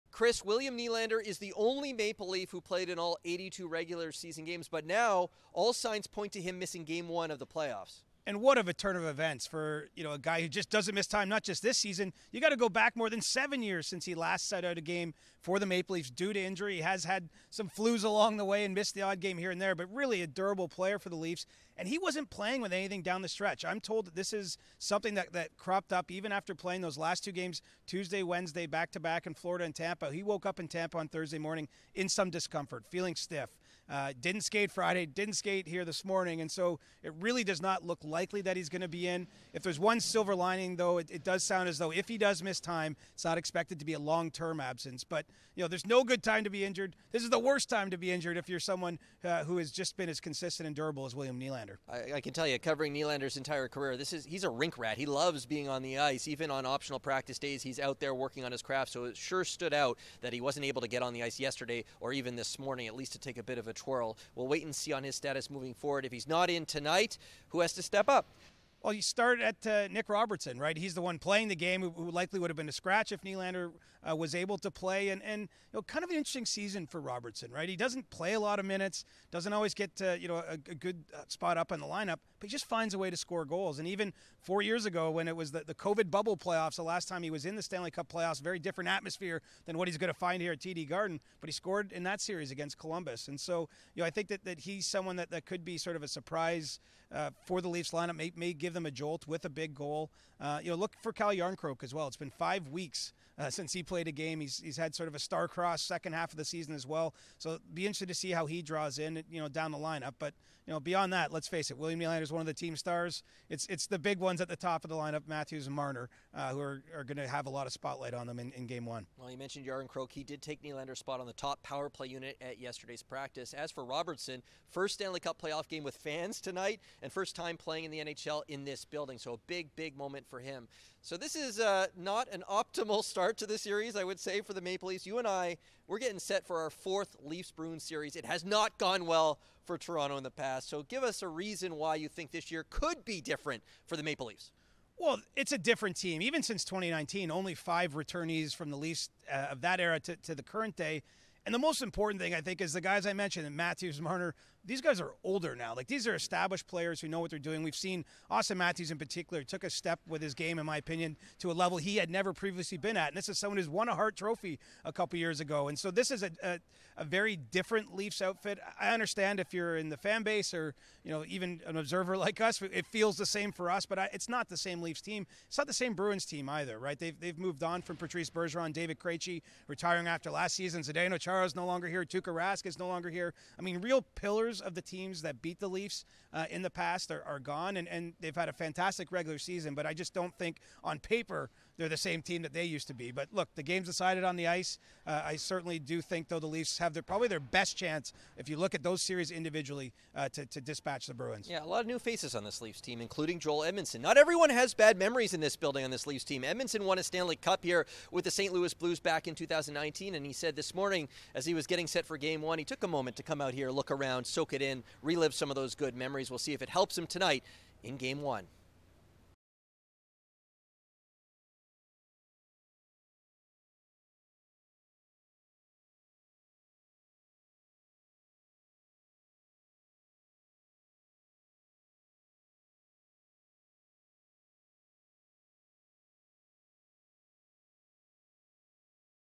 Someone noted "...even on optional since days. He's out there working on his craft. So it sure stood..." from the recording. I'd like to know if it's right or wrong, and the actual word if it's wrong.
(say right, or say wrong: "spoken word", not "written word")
wrong: "practice", not "since".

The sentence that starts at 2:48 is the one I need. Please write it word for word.
I understand if you're in the fan base or you know even an observer like us, it feels the same for us.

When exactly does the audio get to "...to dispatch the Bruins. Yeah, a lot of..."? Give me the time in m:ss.
3:20.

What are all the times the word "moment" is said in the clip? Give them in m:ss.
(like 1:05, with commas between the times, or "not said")
2:09, 3:32.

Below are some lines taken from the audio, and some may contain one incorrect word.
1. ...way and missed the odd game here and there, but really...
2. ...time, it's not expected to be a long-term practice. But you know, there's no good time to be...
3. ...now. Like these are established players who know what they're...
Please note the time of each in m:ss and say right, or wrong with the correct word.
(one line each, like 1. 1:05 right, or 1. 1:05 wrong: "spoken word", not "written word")
1. 0:18 right
2. 0:42 wrong: "absence", not "practice"
3. 2:35 right.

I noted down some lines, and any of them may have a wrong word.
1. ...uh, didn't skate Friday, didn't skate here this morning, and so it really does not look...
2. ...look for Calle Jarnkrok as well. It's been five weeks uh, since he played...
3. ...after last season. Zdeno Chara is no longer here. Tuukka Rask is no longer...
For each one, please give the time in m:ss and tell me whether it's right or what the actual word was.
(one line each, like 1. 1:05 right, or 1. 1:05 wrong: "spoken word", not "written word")
1. 0:33 right
2. 1:40 right
3. 3:00 right.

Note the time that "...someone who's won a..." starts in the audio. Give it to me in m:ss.
2:43.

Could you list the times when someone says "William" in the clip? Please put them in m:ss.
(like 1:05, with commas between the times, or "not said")
0:00, 0:51, 1:51.